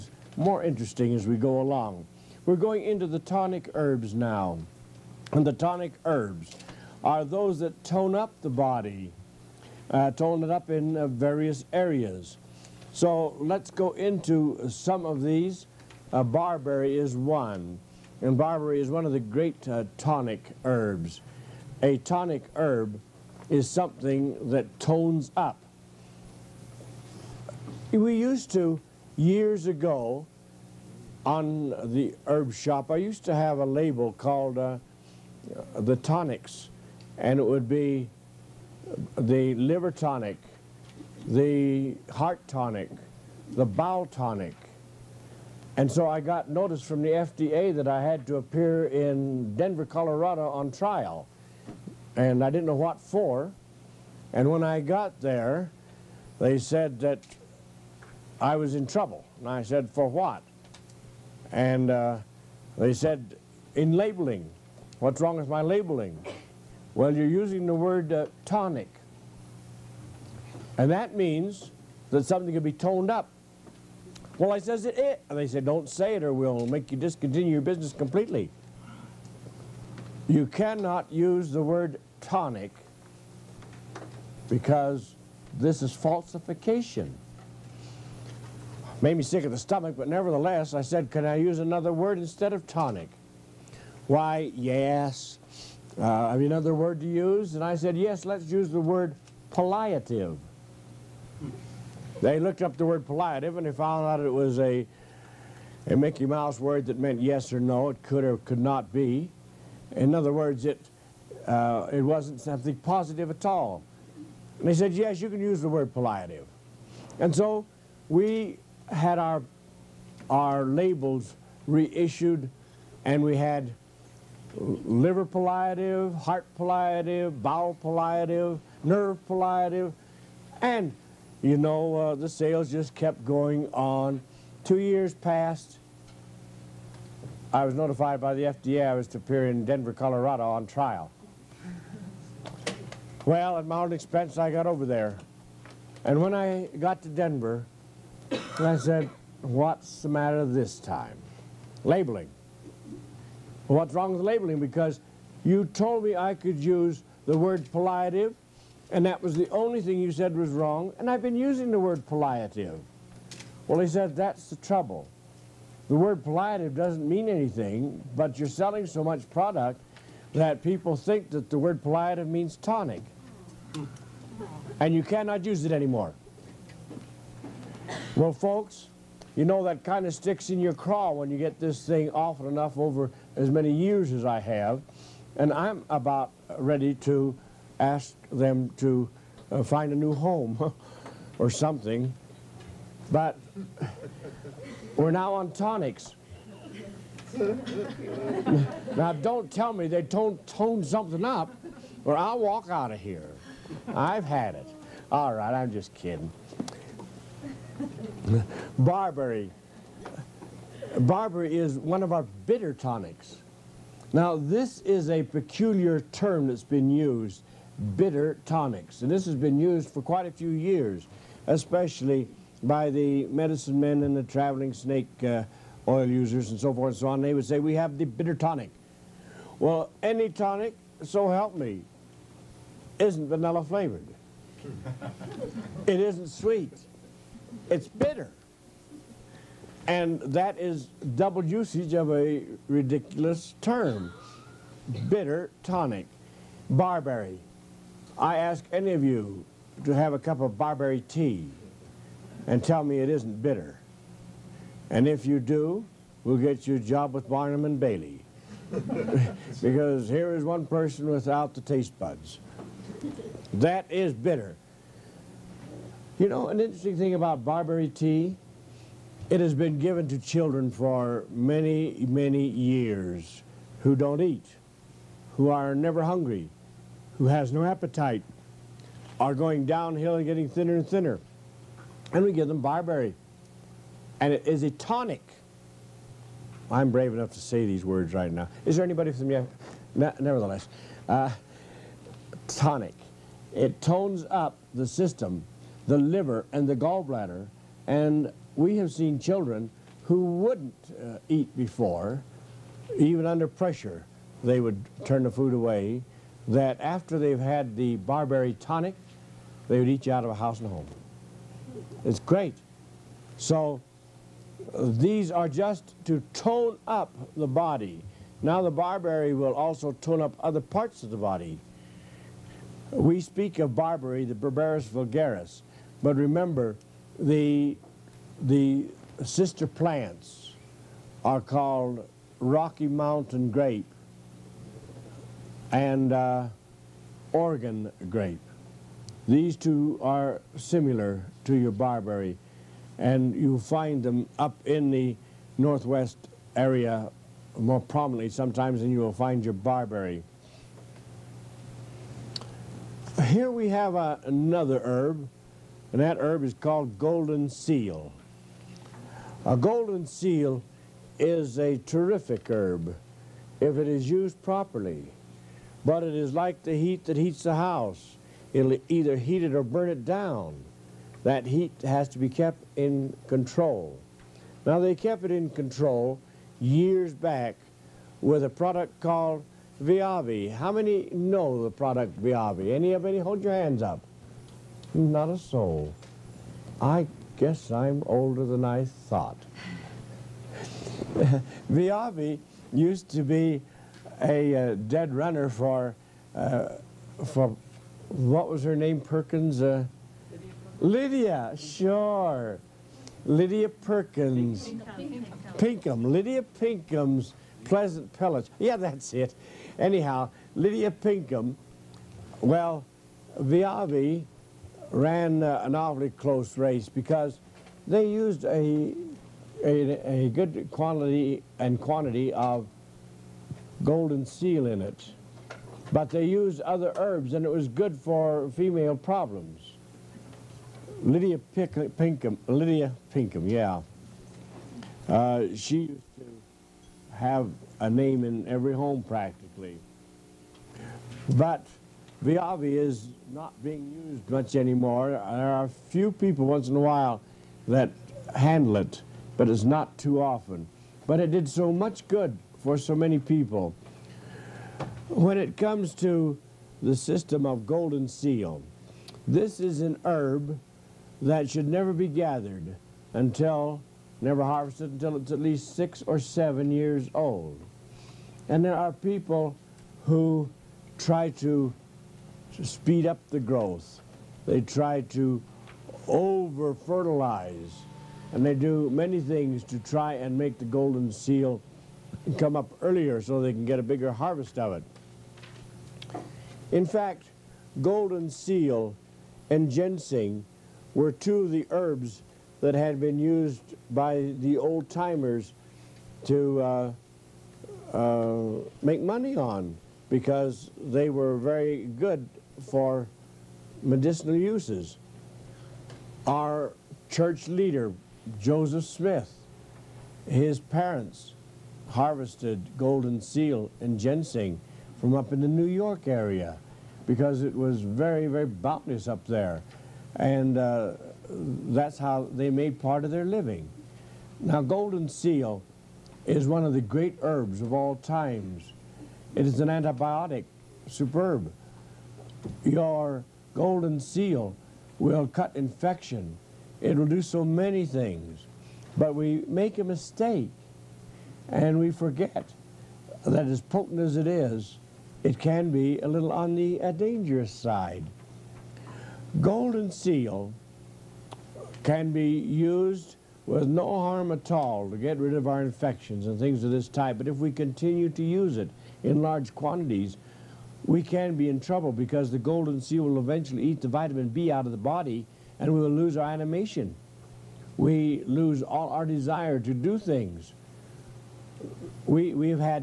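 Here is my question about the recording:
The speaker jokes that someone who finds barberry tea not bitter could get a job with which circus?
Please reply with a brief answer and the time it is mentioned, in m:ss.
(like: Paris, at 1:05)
Barnum and Bailey, at 4:17.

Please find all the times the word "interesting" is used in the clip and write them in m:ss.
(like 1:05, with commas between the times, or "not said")
0:00, 4:26.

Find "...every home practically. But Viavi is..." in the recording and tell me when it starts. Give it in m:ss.
7:18.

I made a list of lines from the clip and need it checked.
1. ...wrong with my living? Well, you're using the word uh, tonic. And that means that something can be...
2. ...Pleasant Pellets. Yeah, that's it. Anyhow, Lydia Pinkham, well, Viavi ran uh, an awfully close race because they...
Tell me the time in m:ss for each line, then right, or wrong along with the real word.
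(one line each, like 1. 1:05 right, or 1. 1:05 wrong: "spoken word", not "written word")
1. 1:05 wrong: "labeling", not "living"
2. 6:47 right.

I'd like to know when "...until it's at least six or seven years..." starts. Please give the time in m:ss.
7:44.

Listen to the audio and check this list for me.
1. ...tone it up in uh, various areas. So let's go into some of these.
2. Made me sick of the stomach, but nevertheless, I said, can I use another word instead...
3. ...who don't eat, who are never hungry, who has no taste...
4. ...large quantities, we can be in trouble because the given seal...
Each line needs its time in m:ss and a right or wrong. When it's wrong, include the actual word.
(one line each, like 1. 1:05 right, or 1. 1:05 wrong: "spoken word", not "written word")
1. 0:10 right
2. 1:29 right
3. 4:33 wrong: "appetite", not "taste"
4. 9:19 wrong: "golden", not "given".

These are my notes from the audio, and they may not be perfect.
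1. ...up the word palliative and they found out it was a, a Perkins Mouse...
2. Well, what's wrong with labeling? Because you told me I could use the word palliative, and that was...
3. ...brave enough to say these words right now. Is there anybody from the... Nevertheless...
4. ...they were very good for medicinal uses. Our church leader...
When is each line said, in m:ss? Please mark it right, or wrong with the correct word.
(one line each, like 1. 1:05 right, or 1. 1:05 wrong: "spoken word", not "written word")
1. 1:42 wrong: "Mickey", not "Perkins"
2. 2:33 right
3. 4:46 right
4. 8:20 right.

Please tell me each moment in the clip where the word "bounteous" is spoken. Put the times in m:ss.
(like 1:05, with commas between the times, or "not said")
8:38.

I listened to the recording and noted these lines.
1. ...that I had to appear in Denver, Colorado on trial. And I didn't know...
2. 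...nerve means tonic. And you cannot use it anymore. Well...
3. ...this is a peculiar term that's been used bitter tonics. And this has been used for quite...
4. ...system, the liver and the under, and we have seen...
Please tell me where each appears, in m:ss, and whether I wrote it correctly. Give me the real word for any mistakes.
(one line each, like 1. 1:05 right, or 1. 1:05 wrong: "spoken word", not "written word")
1. 0:47 right
2. 2:51 wrong: "palliative", not "nerve"
3. 3:34 right
4. 4:54 wrong: "gallbladder", not "under".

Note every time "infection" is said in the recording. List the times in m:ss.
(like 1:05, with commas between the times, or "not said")
8:55, 9:15.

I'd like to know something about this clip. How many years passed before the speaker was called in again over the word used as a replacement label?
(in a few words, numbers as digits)
2.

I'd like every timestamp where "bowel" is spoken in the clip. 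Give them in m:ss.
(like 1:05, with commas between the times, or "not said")
0:43, 2:07.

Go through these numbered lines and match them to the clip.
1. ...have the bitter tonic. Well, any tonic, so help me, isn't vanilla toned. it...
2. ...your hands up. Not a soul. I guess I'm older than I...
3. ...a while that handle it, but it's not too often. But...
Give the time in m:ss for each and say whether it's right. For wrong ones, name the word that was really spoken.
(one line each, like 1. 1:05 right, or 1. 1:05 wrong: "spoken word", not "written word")
1. 3:47 wrong: "flavored", not "toned"
2. 6:23 right
3. 7:26 right.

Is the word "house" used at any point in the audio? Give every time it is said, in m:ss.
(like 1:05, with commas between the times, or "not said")
5:10, 6:07.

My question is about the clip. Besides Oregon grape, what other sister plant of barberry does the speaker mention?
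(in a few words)
Rocky Mountain grape.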